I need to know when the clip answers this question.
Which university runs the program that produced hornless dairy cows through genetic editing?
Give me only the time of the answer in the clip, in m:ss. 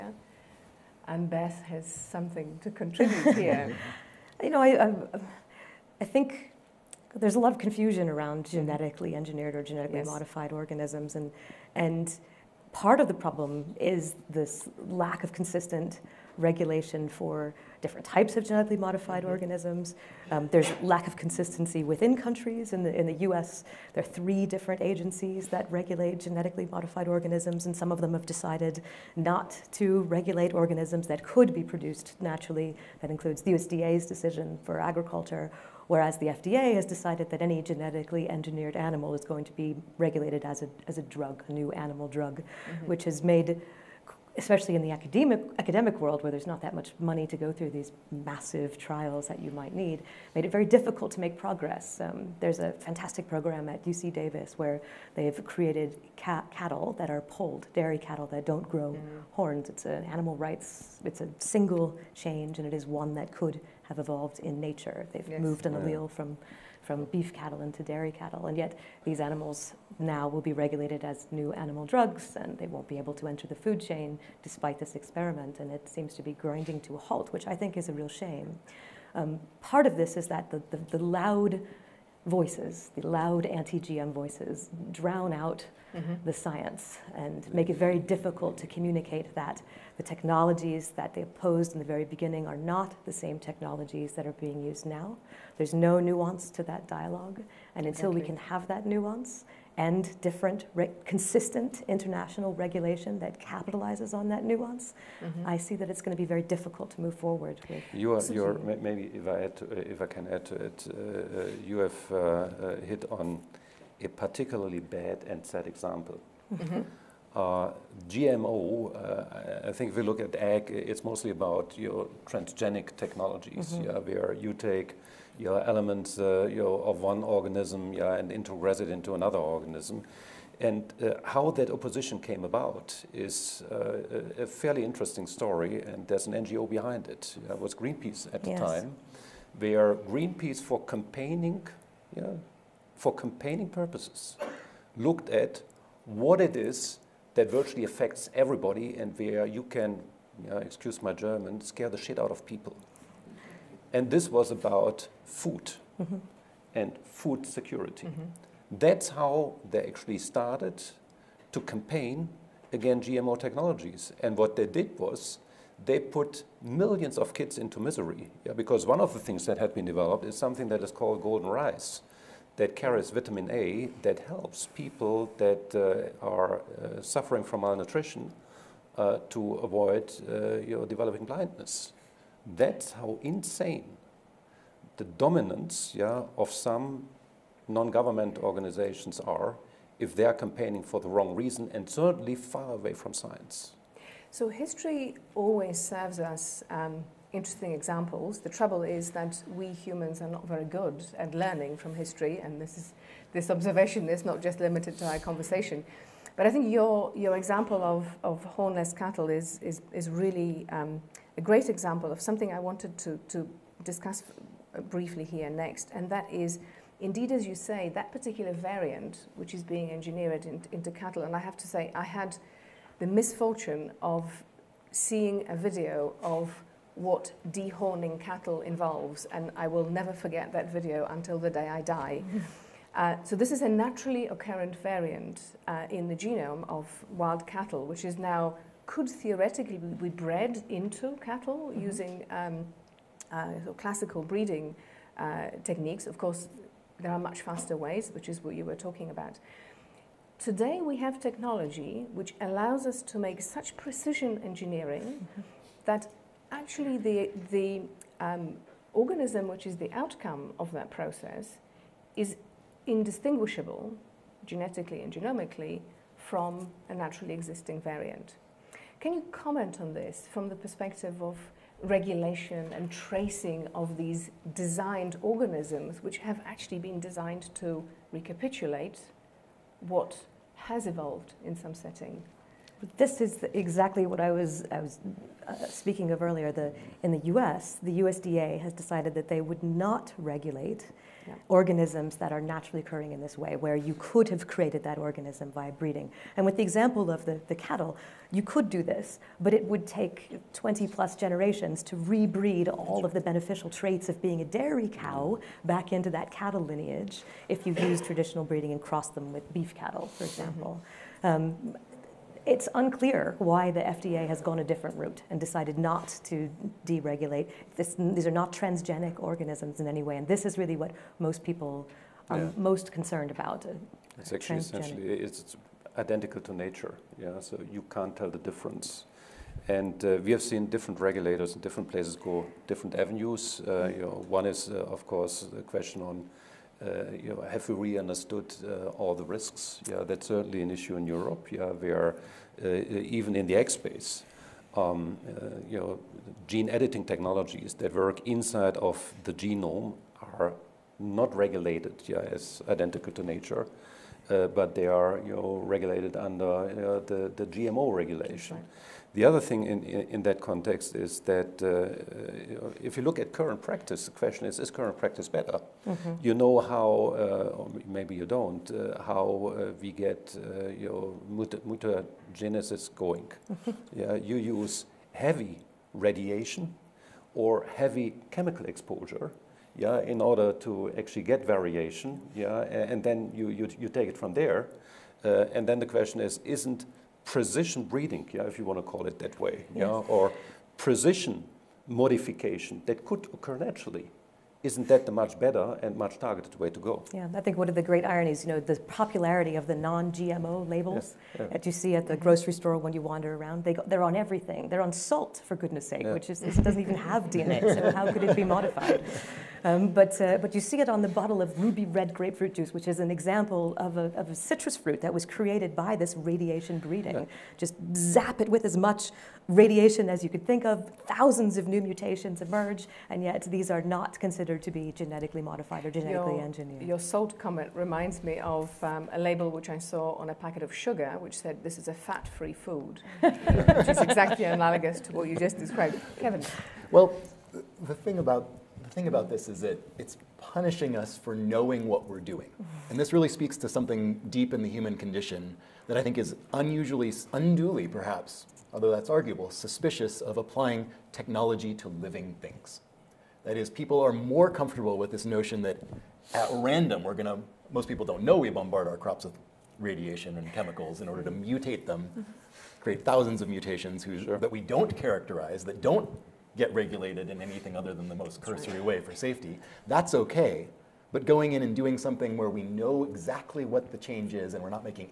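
0:53.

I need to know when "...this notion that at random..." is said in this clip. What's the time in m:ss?
7:35.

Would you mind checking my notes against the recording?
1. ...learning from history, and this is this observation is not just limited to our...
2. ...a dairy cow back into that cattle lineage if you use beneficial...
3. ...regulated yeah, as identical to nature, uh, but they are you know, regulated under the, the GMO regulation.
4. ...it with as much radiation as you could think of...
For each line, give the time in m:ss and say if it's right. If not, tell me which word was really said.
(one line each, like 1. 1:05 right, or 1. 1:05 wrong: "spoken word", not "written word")
1. 3:21 right
2. 5:04 wrong: "traditional", not "beneficial"
3. 5:51 right
4. 6:58 right.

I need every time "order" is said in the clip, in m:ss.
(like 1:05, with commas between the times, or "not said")
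6:20, 7:41.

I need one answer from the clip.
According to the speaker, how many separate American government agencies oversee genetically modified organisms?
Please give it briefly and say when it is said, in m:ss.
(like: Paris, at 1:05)
3, at 0:24.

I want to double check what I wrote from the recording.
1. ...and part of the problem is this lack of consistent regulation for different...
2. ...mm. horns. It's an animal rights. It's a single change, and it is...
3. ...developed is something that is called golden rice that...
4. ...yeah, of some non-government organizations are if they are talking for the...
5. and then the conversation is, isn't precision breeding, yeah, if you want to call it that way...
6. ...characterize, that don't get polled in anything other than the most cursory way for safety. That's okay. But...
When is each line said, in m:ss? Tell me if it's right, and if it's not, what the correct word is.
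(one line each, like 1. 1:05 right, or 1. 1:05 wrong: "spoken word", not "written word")
1. 0:11 right
2. 0:58 right
3. 2:49 right
4. 3:05 wrong: "campaigning", not "talking"
5. 6:25 wrong: "question", not "conversation"
6. 7:44 wrong: "regulated", not "polled".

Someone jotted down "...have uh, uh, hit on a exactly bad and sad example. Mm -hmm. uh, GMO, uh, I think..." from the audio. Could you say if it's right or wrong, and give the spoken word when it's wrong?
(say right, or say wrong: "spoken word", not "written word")
wrong: "particularly", not "exactly".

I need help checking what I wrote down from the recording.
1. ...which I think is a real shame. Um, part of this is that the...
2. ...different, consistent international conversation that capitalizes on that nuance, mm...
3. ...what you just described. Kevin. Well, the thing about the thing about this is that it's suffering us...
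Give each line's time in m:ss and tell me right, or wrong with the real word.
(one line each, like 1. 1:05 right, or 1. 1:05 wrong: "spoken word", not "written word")
1. 1:17 right
2. 1:40 wrong: "regulation", not "conversation"
3. 7:15 wrong: "punishing", not "suffering".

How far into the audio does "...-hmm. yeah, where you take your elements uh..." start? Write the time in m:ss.
2:03.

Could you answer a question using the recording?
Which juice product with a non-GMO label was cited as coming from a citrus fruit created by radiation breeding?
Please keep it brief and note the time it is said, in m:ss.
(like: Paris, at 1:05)
ruby red grapefruit juice, at 6:51.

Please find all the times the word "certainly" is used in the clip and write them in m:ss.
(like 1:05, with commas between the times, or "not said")
3:11, 5:40.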